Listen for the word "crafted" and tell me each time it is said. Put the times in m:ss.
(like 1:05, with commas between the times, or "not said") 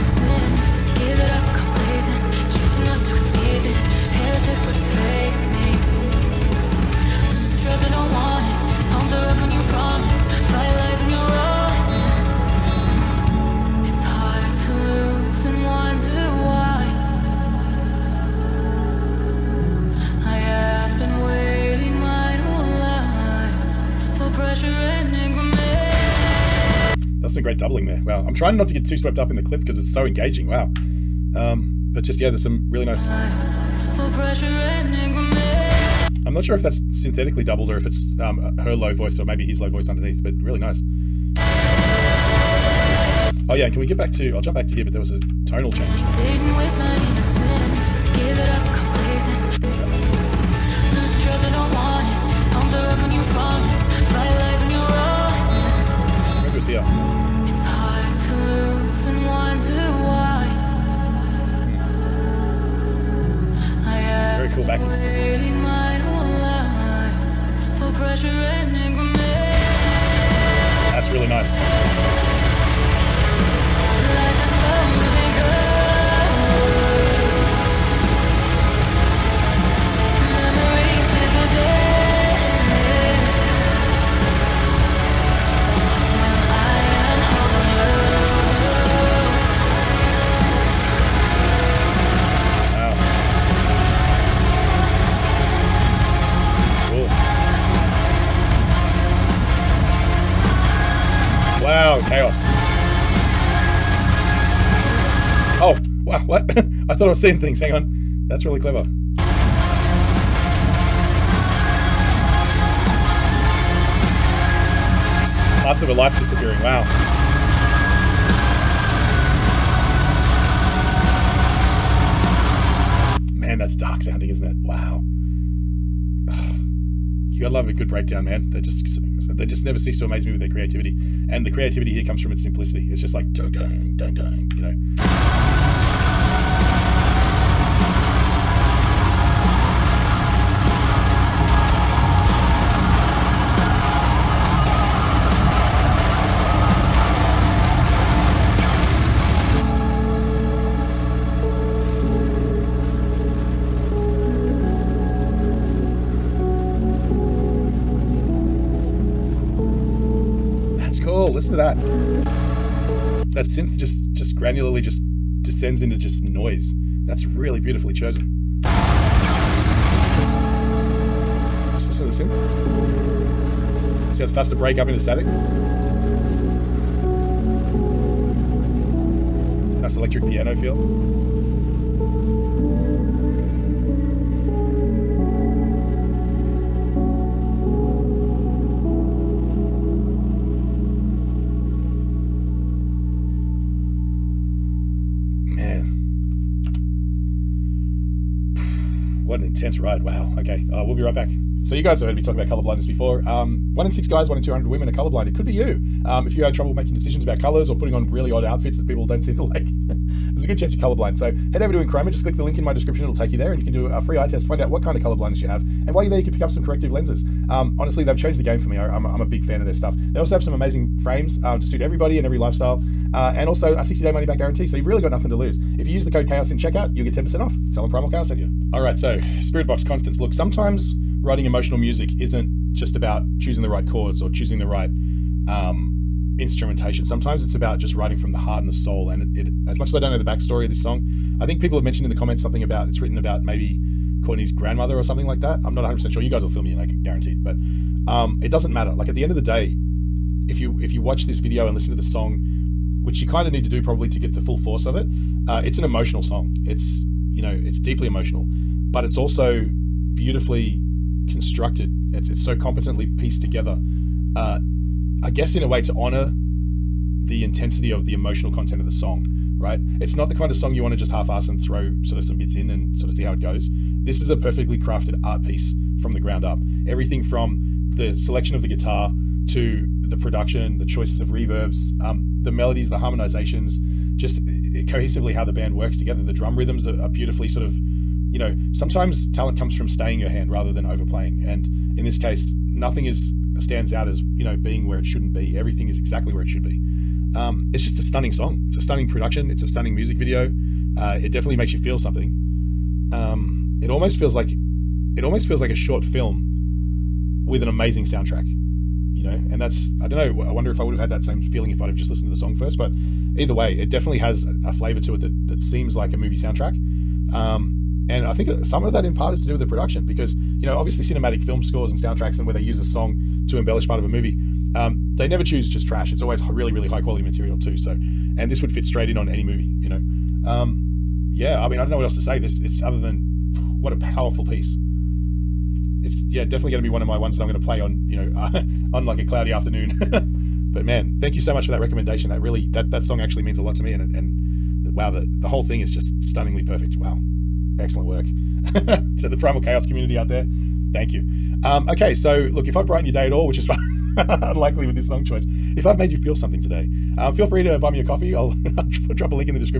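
4:34.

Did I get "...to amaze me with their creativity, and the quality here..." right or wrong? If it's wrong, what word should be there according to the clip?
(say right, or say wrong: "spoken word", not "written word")
wrong: "creativity", not "quality".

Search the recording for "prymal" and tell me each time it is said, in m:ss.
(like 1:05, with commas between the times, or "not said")
3:47, 5:49.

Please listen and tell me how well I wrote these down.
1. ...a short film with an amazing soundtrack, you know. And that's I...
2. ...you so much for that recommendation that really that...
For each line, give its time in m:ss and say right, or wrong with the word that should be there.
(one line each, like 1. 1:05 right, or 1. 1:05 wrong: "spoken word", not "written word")
1. 5:05 right
2. 5:41 right.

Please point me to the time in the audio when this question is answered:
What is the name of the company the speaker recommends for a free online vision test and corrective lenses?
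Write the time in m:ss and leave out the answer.
3:31.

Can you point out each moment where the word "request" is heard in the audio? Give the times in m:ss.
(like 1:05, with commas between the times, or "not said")
not said.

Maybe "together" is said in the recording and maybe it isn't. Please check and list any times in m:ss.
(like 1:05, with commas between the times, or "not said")
4:23, 4:45.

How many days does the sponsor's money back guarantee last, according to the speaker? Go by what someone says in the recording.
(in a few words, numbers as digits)
60.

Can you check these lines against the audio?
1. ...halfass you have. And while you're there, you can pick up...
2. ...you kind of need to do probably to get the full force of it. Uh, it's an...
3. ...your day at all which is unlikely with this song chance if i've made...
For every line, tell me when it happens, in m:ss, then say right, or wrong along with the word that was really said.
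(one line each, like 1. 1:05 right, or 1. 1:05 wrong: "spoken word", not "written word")
1. 3:35 wrong: "colorblindness", not "halfass"
2. 4:13 right
3. 5:53 wrong: "choice", not "chance".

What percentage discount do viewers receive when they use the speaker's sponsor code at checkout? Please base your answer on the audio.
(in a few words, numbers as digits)
10%.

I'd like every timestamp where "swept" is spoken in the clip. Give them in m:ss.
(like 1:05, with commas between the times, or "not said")
0:28.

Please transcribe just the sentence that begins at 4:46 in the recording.
The drum rhythms are, are, beautifully sort of, you know, sometimes talent comes from staying your hand rather than overplaying.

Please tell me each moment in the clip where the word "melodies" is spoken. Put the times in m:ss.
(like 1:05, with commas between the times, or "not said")
4:42.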